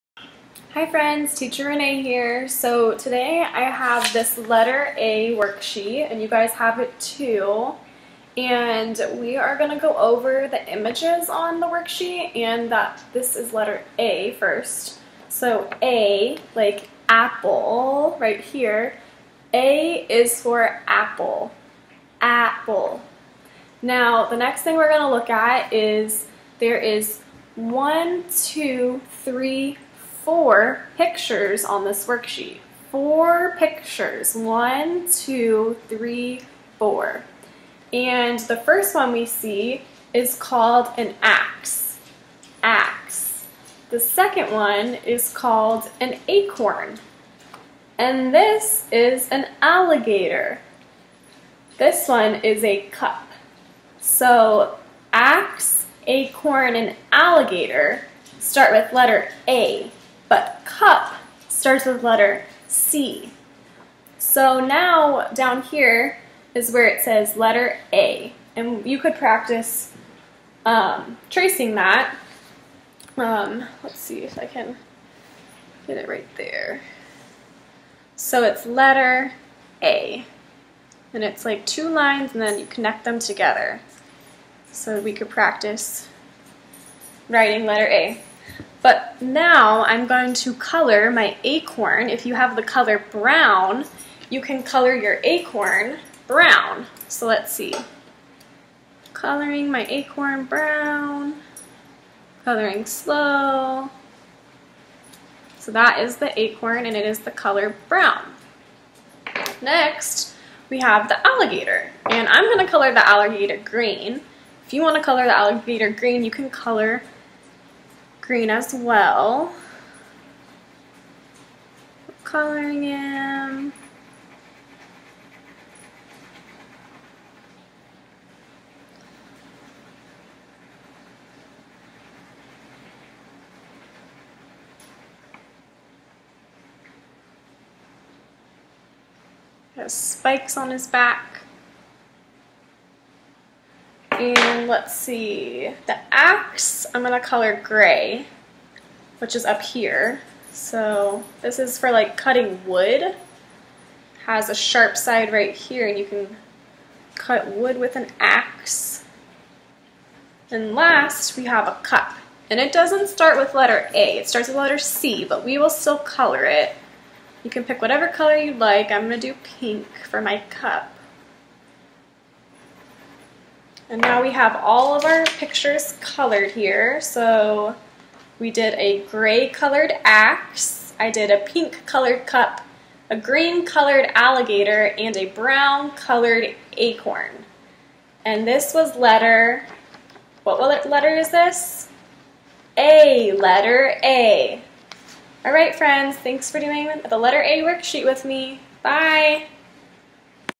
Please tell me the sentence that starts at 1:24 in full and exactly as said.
So we could practice writing letter A.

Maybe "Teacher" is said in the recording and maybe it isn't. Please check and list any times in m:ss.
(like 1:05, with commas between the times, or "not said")
0:01.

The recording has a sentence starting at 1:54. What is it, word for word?
If you wanna color the alligator green, you can color green as well.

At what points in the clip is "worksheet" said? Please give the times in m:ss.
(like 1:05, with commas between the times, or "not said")
0:05, 0:11, 0:32, 3:17.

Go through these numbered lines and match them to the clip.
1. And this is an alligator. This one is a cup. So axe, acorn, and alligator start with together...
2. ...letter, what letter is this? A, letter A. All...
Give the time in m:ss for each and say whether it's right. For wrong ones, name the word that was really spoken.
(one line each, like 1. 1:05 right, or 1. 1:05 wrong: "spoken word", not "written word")
1. 0:47 wrong: "letter", not "together"
2. 3:08 right.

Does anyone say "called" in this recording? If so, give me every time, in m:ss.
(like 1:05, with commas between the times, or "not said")
0:40, 0:45.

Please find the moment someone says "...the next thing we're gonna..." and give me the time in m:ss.
0:24.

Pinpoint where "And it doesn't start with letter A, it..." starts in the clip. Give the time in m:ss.
2:42.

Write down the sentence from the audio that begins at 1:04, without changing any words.
So now down here is where it says letter A.